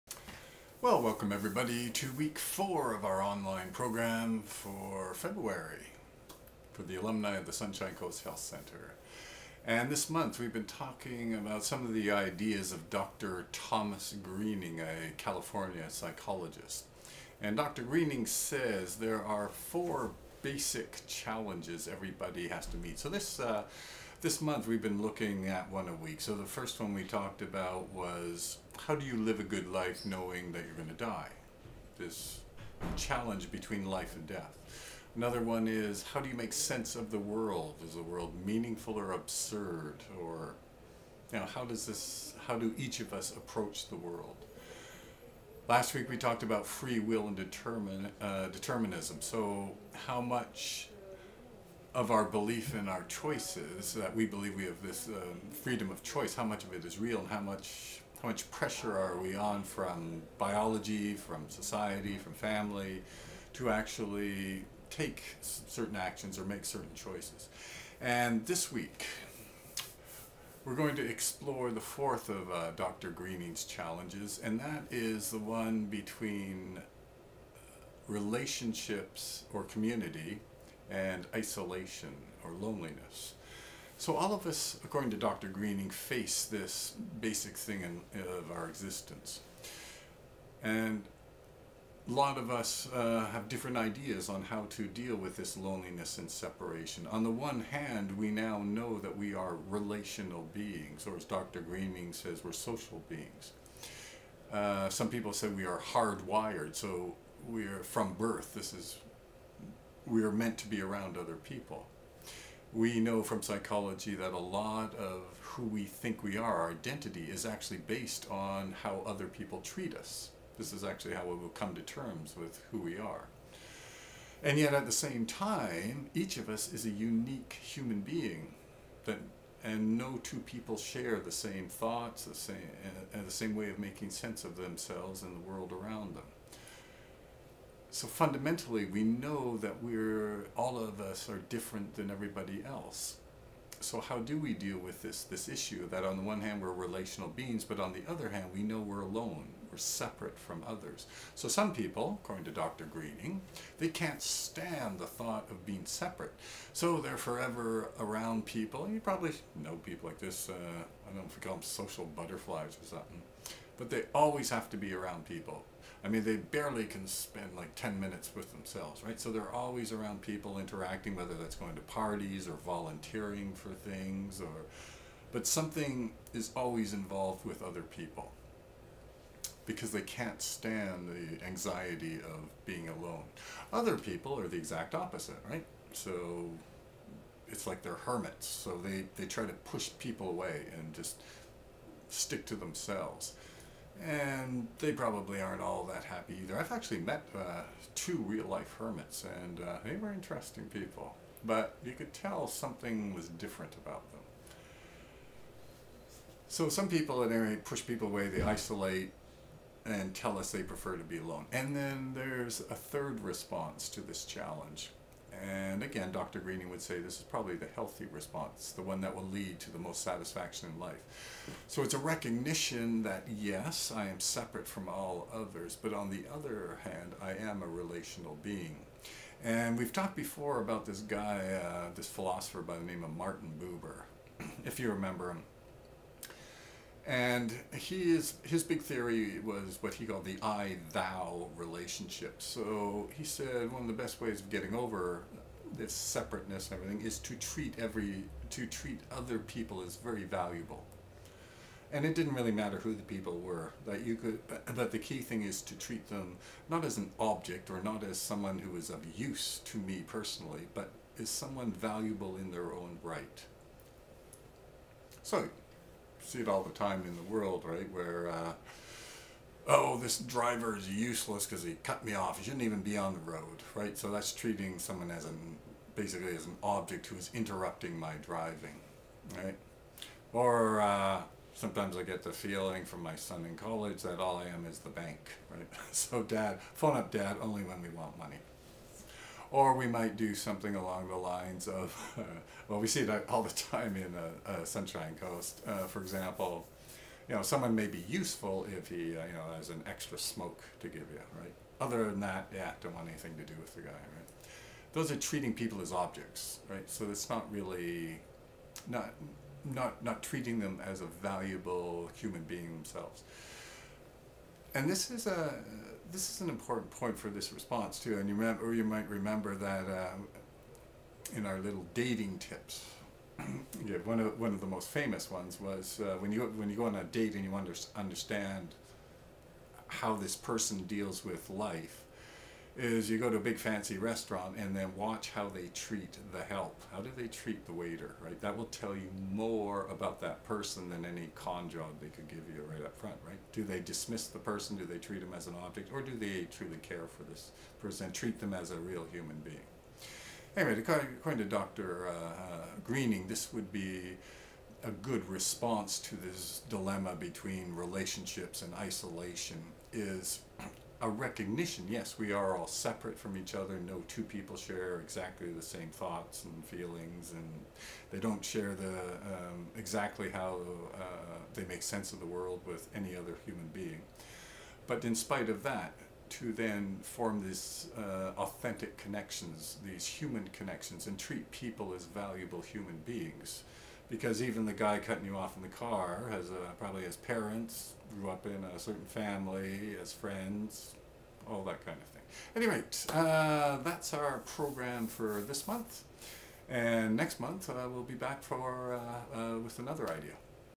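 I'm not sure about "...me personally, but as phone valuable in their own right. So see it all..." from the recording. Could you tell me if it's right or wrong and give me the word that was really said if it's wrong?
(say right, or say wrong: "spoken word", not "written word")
wrong: "someone", not "phone".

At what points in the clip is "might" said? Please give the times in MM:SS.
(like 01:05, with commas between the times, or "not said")
04:49, 05:18.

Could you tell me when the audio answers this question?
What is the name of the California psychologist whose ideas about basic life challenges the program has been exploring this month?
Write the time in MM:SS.
00:12.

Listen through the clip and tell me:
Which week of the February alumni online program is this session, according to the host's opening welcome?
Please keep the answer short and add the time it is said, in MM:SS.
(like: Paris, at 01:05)
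4, at 00:02.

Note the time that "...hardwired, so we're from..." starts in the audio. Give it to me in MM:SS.
01:45.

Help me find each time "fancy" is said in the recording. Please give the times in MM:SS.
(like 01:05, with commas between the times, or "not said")
05:33.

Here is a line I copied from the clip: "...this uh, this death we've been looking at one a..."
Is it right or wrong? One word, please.
wrong.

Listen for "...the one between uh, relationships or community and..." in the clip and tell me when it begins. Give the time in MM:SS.
01:15.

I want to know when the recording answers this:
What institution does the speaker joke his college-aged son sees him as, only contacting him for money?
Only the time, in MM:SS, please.
04:44.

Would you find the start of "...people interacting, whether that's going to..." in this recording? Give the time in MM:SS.
02:50.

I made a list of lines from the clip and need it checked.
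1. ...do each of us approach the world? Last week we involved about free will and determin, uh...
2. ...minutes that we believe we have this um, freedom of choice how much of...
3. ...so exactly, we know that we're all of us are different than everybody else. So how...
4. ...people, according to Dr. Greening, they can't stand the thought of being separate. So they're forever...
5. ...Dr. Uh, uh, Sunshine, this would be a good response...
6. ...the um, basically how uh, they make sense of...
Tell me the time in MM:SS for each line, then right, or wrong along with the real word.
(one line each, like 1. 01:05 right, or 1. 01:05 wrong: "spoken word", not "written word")
1. 00:42 wrong: "talked", not "involved"
2. 00:53 wrong: "choices", not "minutes"
3. 02:17 wrong: "fundamentally", not "exactly"
4. 02:31 right
5. 05:51 wrong: "Greening", not "Sunshine"
6. 06:08 wrong: "exactly", not "basically".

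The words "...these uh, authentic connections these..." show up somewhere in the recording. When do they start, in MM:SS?
06:17.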